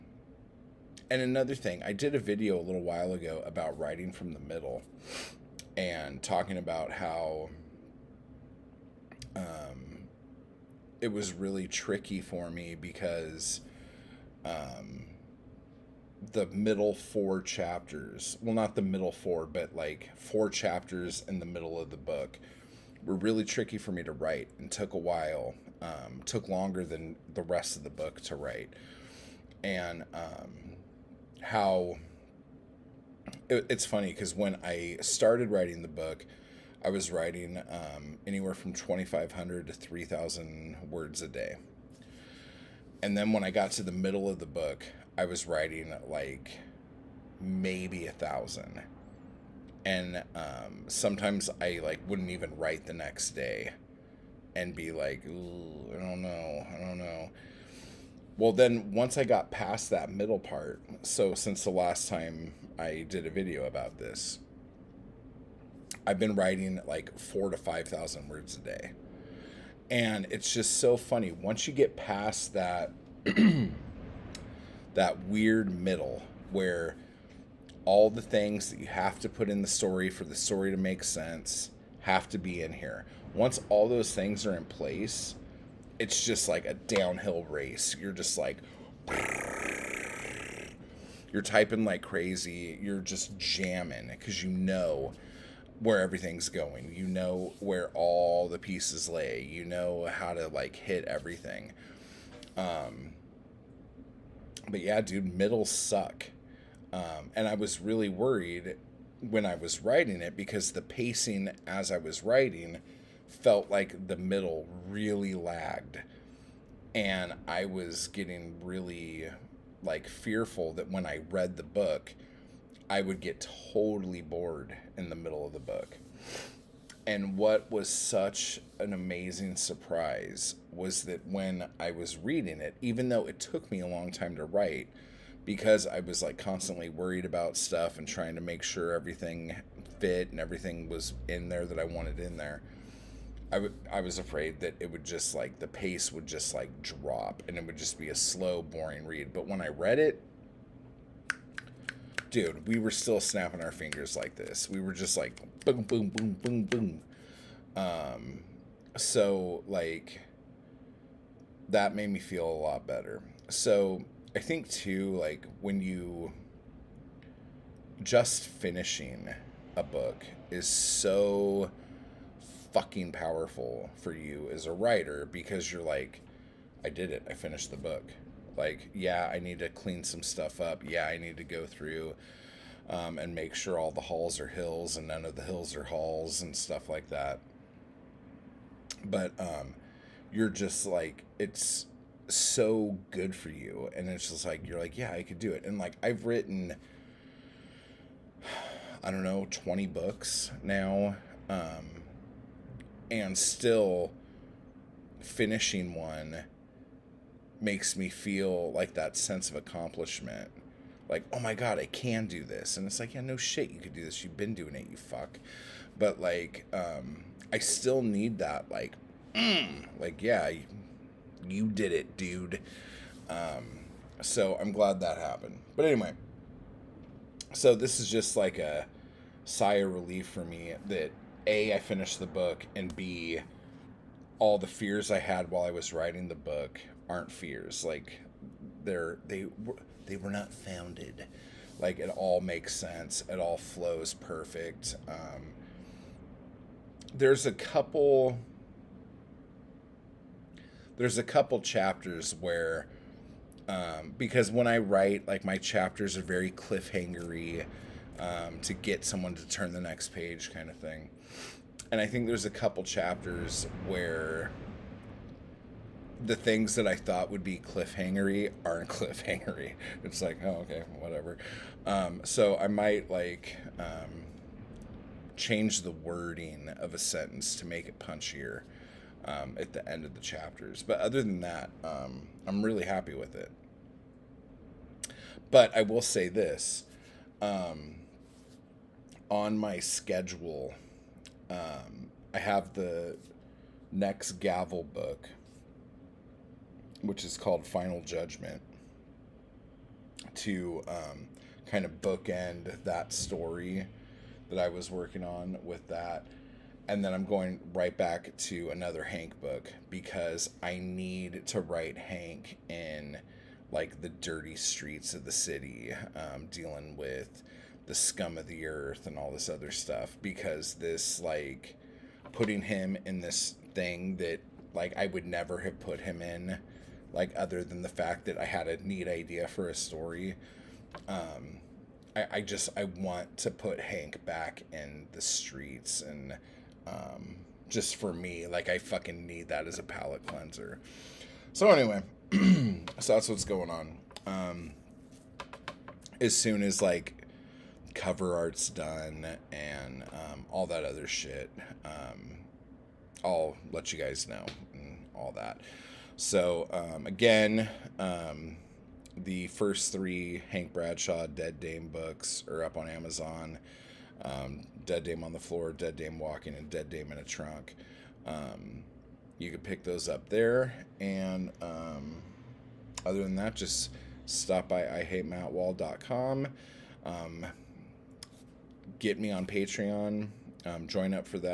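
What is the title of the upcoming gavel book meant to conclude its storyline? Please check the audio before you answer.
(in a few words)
Final Judgment.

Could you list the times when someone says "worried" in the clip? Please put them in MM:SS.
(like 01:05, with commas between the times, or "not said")
01:48, 02:16.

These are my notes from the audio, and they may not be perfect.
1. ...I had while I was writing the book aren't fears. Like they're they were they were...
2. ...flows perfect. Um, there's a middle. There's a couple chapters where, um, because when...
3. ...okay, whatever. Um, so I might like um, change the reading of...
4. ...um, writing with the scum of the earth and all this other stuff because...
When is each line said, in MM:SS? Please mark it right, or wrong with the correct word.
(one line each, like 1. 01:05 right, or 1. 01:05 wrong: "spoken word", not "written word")
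1. 03:55 right
2. 04:03 wrong: "couple", not "middle"
3. 04:30 wrong: "wording", not "reading"
4. 05:16 wrong: "dealing", not "writing".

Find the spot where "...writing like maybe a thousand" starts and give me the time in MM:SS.
00:45.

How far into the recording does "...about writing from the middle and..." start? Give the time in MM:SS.
00:03.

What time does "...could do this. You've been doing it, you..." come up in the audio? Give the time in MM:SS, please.
03:33.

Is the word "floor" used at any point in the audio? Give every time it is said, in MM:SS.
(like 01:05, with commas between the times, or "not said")
06:05.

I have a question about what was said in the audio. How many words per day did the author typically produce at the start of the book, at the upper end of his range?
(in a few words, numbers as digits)
3,000.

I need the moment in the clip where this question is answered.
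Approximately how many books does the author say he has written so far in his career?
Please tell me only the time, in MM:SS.
03:19.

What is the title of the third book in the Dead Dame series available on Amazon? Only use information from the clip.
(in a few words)
Dead Dame in a Trunk.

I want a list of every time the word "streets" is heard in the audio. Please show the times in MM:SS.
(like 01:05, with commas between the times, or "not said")
05:14, 05:35.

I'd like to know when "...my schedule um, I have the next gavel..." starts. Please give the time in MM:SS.
04:49.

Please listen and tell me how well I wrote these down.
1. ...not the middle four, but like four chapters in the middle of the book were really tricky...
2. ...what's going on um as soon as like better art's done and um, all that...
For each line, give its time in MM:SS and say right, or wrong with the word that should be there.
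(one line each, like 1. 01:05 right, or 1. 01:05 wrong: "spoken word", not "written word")
1. 00:18 right
2. 05:43 wrong: "cover", not "better".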